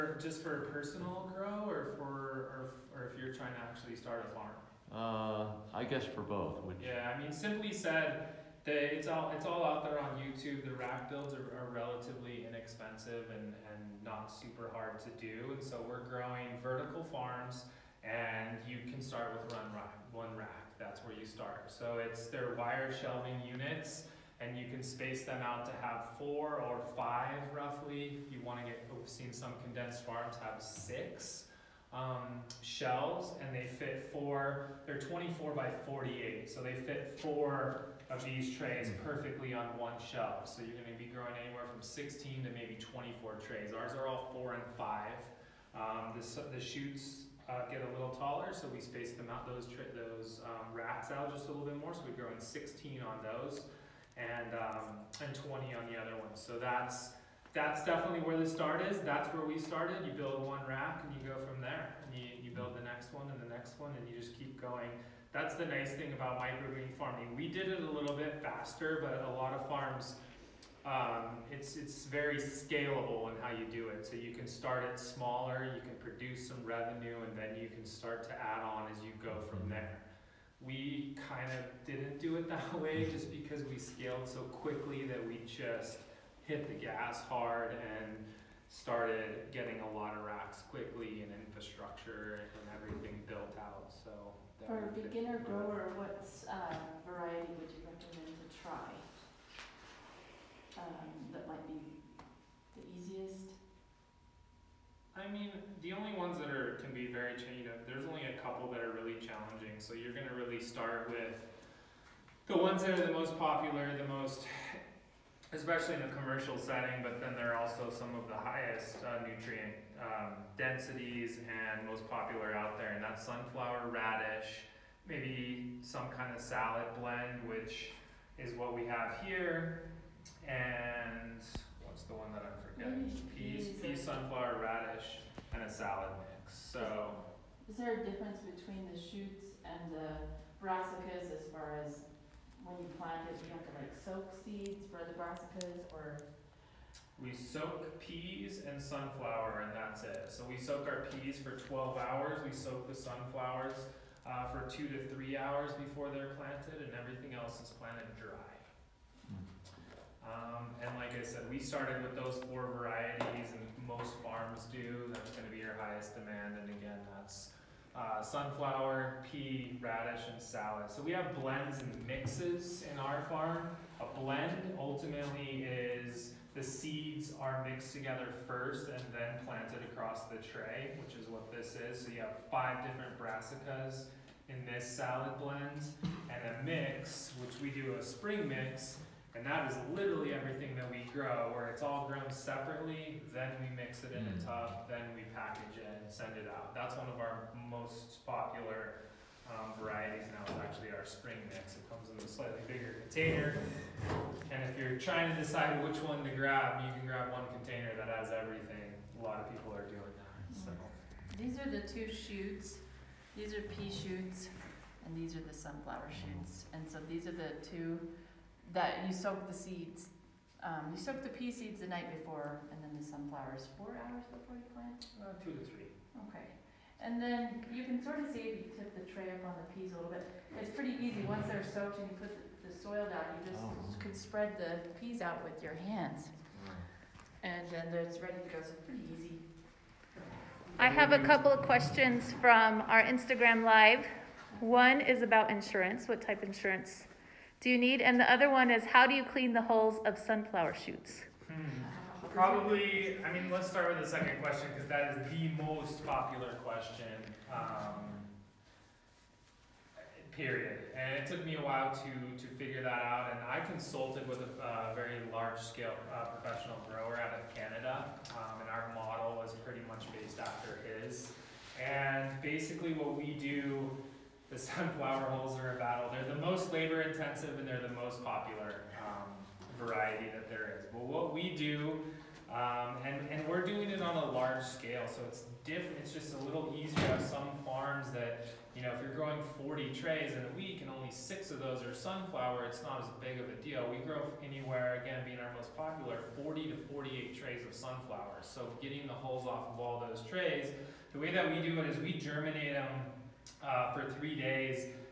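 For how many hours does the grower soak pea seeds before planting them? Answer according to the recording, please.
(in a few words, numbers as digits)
12 hours.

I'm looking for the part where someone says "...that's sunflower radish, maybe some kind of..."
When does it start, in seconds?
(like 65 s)
123 s.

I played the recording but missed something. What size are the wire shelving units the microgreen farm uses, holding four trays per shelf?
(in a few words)
24 by 48.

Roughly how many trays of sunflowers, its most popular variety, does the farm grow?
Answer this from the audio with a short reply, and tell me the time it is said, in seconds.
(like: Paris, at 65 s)
40 to 48, at 296 s.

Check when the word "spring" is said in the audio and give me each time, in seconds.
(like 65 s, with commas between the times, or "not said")
188 s, 201 s.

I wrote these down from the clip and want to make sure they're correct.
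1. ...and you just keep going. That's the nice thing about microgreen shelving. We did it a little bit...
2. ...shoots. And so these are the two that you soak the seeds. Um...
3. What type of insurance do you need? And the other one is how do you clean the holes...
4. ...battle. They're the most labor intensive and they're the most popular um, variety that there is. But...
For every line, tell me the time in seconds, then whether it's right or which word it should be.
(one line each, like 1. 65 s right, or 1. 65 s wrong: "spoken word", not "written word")
1. 63 s wrong: "farming", not "shelving"
2. 216 s right
3. 246 s right
4. 275 s right.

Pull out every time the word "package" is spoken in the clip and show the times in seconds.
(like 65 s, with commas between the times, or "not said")
195 s.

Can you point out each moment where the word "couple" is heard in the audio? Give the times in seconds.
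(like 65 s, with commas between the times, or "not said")
108 s, 241 s.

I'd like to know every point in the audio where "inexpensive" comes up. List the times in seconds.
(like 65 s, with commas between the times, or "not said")
12 s.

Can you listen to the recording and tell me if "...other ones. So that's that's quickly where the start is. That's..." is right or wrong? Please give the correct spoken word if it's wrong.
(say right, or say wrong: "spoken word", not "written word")
wrong: "definitely", not "quickly".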